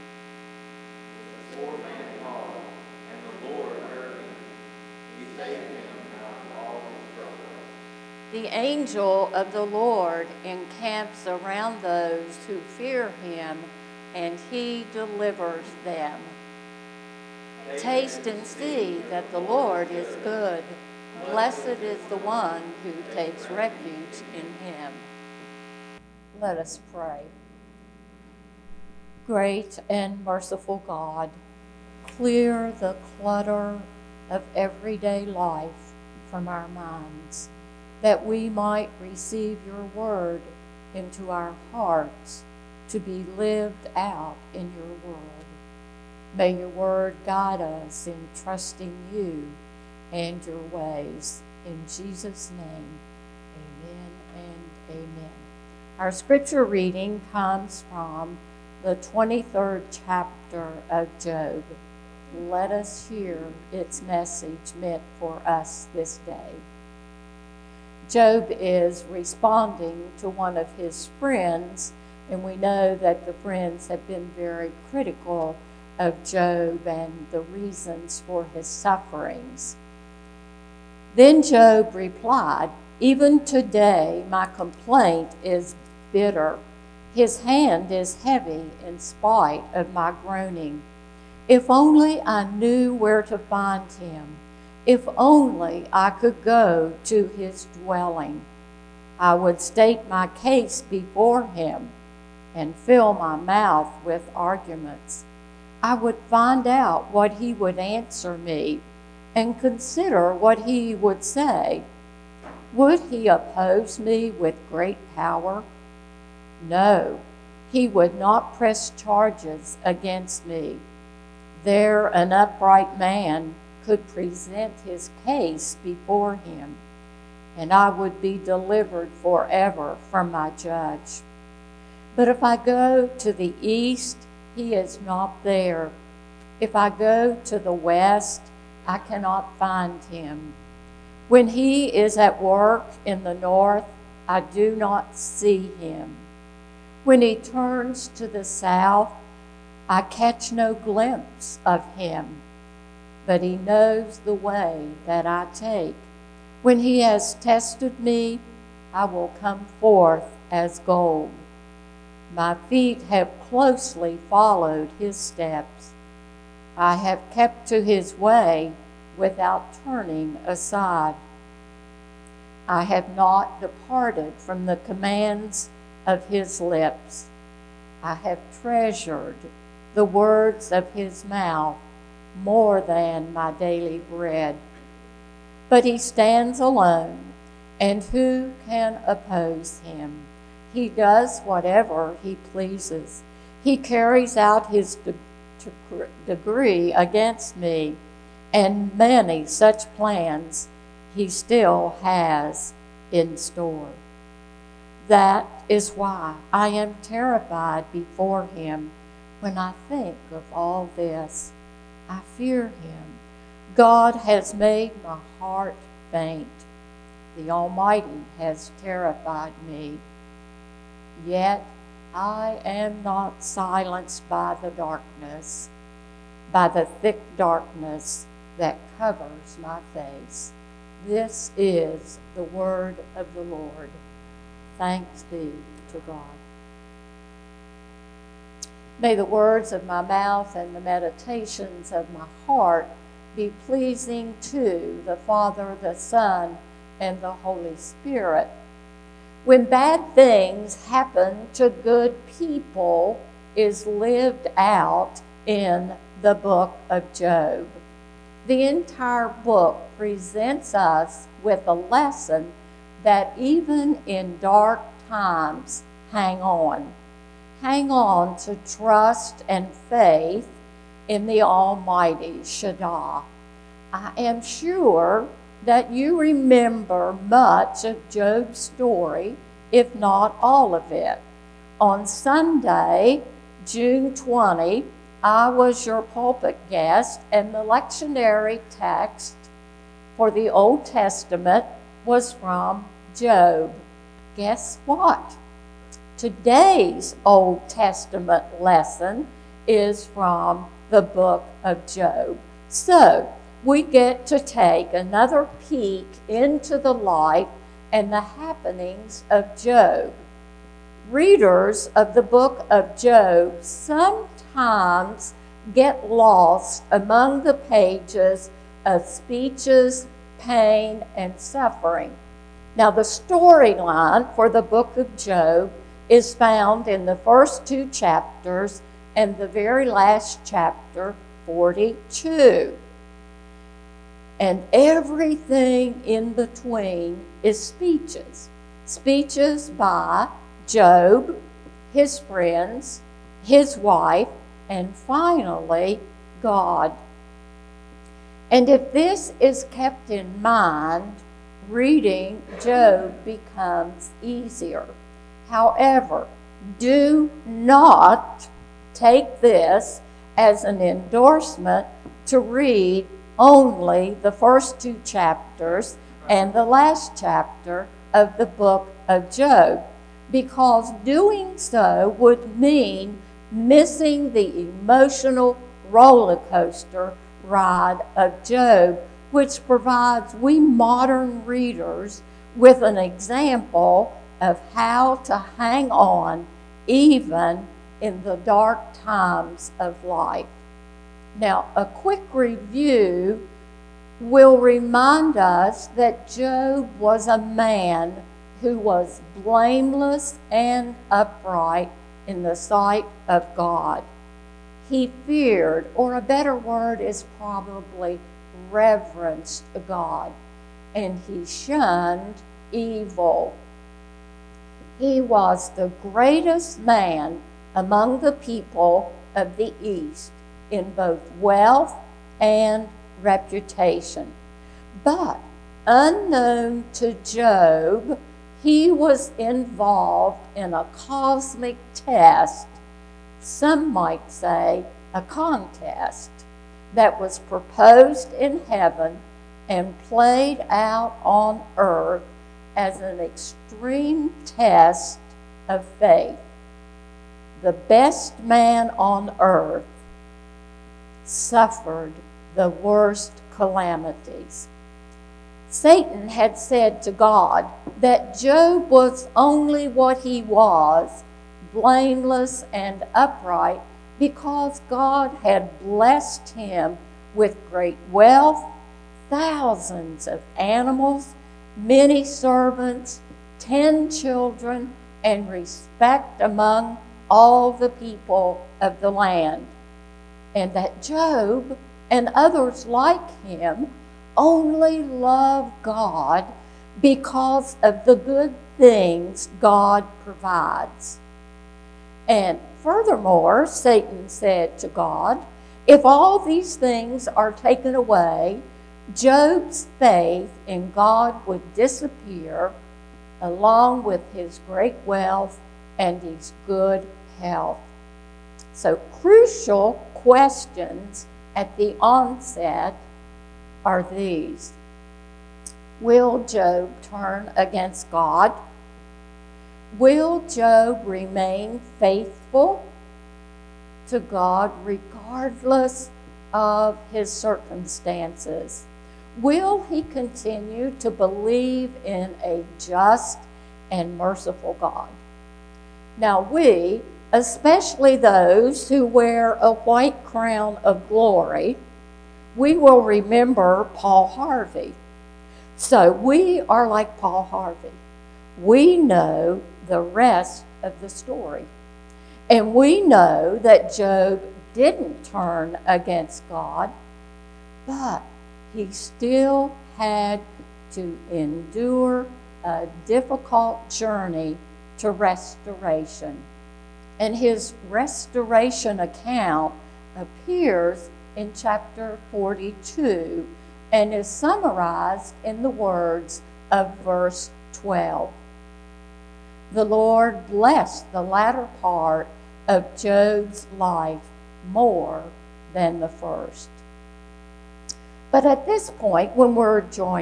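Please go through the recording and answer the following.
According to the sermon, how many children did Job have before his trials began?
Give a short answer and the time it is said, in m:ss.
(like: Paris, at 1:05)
10, at 7:53.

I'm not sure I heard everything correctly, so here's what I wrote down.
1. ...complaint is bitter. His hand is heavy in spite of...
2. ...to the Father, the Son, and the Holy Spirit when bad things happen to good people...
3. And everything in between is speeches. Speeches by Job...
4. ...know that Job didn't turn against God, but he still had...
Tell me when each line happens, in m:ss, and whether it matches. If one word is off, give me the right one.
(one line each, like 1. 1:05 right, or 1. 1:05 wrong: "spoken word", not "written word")
1. 1:24 right
2. 4:04 right
3. 5:34 right
4. 9:12 right.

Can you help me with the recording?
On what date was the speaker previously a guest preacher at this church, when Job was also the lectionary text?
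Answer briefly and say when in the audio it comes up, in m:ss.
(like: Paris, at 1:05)
June 20, at 4:43.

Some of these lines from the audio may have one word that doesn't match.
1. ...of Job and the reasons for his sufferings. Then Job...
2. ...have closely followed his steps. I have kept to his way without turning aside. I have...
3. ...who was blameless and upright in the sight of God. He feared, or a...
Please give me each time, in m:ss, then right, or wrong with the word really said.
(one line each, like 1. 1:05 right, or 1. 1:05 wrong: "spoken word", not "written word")
1. 1:15 right
2. 2:43 right
3. 6:38 right.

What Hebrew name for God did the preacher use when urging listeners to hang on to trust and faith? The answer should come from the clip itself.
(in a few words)
Shaddai.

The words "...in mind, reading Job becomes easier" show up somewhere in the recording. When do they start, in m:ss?
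5:50.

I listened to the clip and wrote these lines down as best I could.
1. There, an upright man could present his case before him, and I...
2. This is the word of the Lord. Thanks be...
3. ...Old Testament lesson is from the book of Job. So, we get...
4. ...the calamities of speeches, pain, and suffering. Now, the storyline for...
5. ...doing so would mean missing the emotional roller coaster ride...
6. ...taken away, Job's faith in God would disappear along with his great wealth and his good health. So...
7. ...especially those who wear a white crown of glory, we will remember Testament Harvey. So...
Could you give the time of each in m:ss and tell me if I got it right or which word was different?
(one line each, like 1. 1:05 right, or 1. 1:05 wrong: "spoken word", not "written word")
1. 2:01 right
2. 3:51 right
3. 4:57 right
4. 5:17 wrong: "pages", not "calamities"
5. 6:11 right
6. 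8:17 right
7. 8:57 wrong: "Paul", not "Testament".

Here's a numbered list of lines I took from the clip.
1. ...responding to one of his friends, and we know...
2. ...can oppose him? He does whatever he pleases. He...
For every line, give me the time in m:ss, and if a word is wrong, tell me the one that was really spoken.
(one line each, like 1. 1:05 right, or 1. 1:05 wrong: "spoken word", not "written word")
1. 1:09 right
2. 3:08 right.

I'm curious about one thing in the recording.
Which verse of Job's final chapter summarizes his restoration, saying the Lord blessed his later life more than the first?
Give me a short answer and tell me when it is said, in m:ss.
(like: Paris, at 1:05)
Verse 12, at 9:36.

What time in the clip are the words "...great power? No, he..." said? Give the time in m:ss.
1:54.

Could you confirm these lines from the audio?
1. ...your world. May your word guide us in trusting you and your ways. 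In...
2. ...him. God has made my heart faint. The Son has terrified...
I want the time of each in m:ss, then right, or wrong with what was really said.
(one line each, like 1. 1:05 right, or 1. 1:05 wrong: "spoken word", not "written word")
1. 0:44 right
2. 3:32 wrong: "Almighty", not "Son".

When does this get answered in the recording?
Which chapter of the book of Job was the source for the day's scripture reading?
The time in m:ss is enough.
0:58.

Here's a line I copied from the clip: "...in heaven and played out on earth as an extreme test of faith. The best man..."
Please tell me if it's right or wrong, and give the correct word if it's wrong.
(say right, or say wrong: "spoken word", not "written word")
right.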